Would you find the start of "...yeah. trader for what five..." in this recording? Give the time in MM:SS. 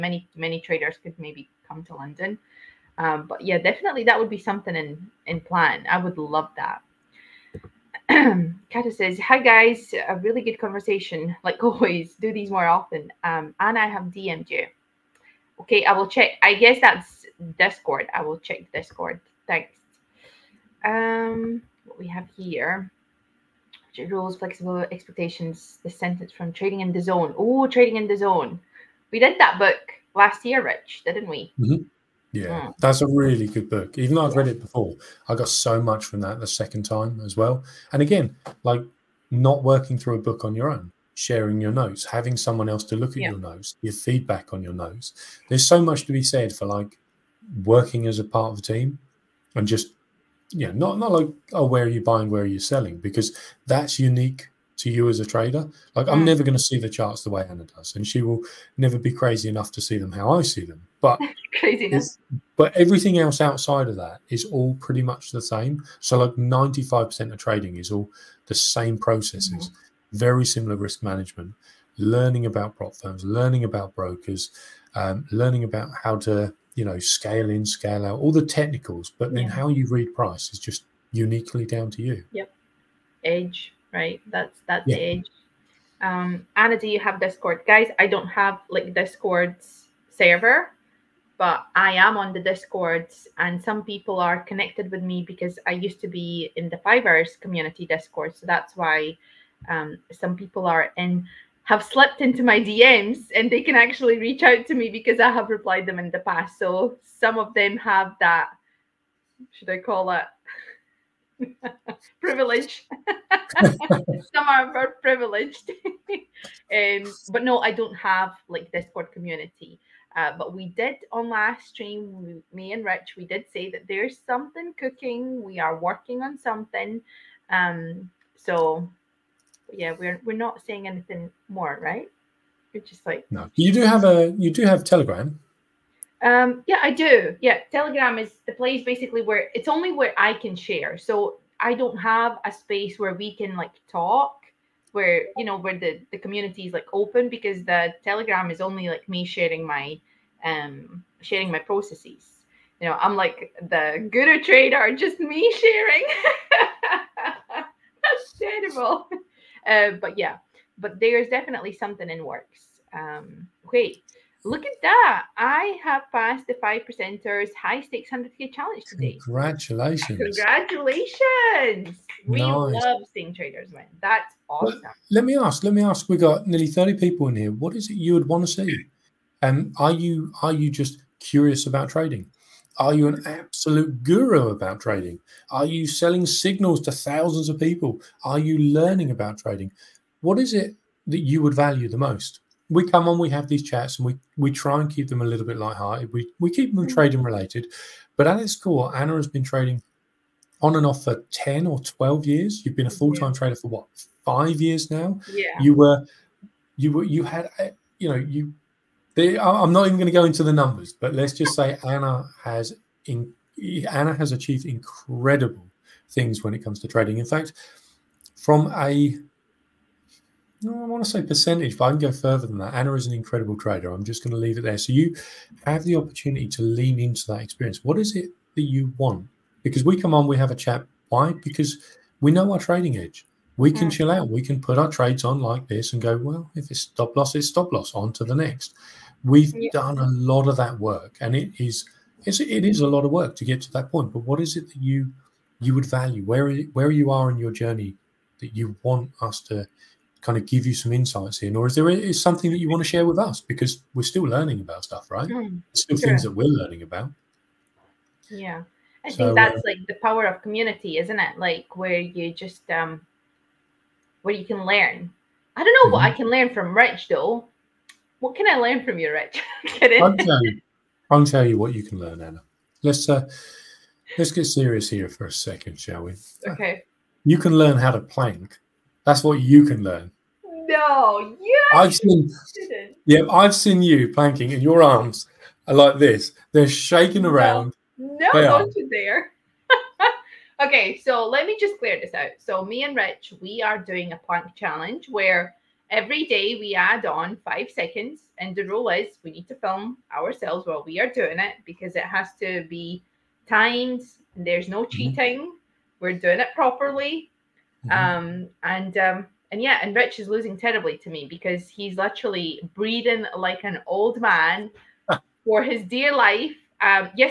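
03:23.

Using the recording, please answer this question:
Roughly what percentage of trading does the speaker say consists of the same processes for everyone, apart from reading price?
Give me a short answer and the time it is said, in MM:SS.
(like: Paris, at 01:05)
95%, at 01:06.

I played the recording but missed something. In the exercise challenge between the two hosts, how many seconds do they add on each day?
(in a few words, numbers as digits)
5.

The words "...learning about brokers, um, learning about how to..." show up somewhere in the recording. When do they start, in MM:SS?
01:13.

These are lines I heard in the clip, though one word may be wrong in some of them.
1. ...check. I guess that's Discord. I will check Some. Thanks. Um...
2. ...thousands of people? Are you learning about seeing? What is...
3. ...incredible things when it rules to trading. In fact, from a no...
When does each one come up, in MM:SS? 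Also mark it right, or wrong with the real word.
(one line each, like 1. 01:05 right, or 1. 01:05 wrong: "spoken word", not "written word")
1. 00:16 wrong: "Discord", not "Some"
2. 03:06 wrong: "trading", not "seeing"
3. 03:34 wrong: "comes", not "rules".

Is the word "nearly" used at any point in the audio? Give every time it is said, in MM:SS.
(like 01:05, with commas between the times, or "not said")
02:56.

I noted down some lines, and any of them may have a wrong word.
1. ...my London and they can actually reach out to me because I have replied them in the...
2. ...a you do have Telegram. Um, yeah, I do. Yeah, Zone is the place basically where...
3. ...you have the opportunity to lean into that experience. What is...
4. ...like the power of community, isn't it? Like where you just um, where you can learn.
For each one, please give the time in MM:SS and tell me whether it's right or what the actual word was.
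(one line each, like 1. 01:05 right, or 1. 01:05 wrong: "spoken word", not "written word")
1. 01:42 wrong: "DMs", not "London"
2. 02:14 wrong: "Telegram", not "Zone"
3. 03:44 right
4. 04:19 right.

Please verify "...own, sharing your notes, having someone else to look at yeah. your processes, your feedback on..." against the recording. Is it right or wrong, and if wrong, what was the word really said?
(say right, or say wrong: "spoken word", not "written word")
wrong: "notes", not "processes".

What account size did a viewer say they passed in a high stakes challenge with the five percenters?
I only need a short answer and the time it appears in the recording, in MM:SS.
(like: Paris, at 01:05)
100k, at 02:48.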